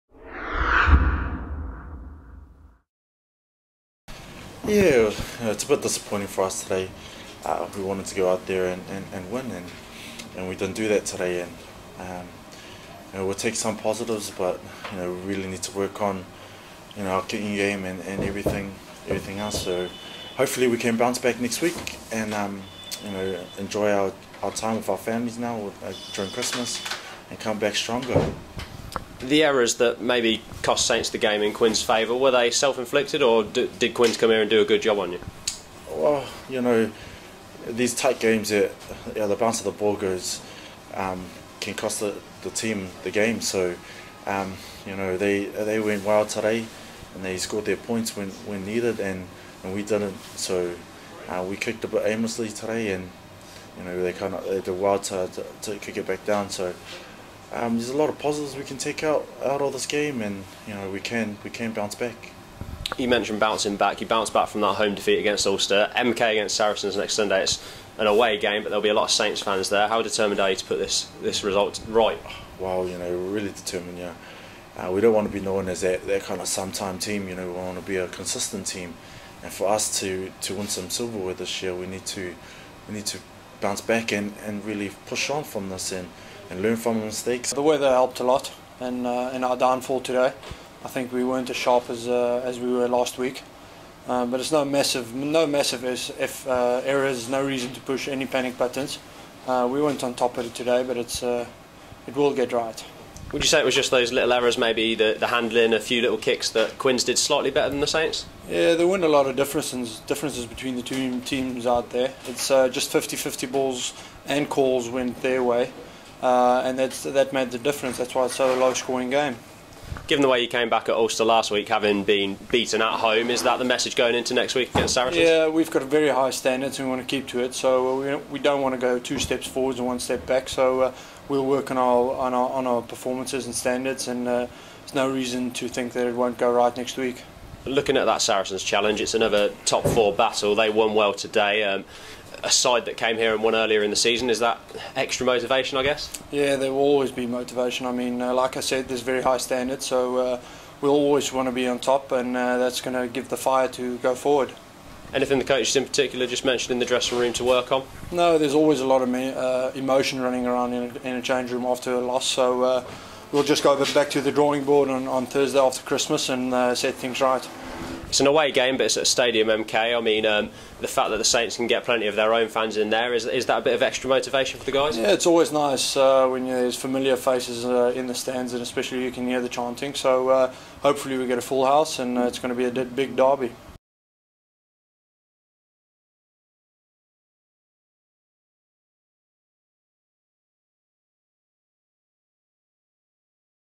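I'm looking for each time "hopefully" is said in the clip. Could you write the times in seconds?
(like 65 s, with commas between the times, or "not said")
20 s, 180 s.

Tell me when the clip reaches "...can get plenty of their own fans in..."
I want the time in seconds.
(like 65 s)
171 s.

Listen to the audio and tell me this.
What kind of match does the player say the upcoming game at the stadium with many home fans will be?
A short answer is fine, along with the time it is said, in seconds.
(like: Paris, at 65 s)
A big derby, at 182 s.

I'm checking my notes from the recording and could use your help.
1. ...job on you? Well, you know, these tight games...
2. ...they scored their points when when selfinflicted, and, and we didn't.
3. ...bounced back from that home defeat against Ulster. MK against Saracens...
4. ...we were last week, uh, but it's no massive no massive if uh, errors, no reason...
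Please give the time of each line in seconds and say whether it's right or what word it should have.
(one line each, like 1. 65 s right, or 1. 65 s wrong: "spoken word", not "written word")
1. 34 s right
2. 47 s wrong: "needed", not "selfinflicted"
3. 64 s right
4. 92 s right.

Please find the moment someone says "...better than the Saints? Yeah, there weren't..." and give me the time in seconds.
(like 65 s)
107 s.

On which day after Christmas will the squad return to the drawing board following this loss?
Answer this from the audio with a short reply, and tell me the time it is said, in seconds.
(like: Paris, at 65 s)
Thursday, at 165 s.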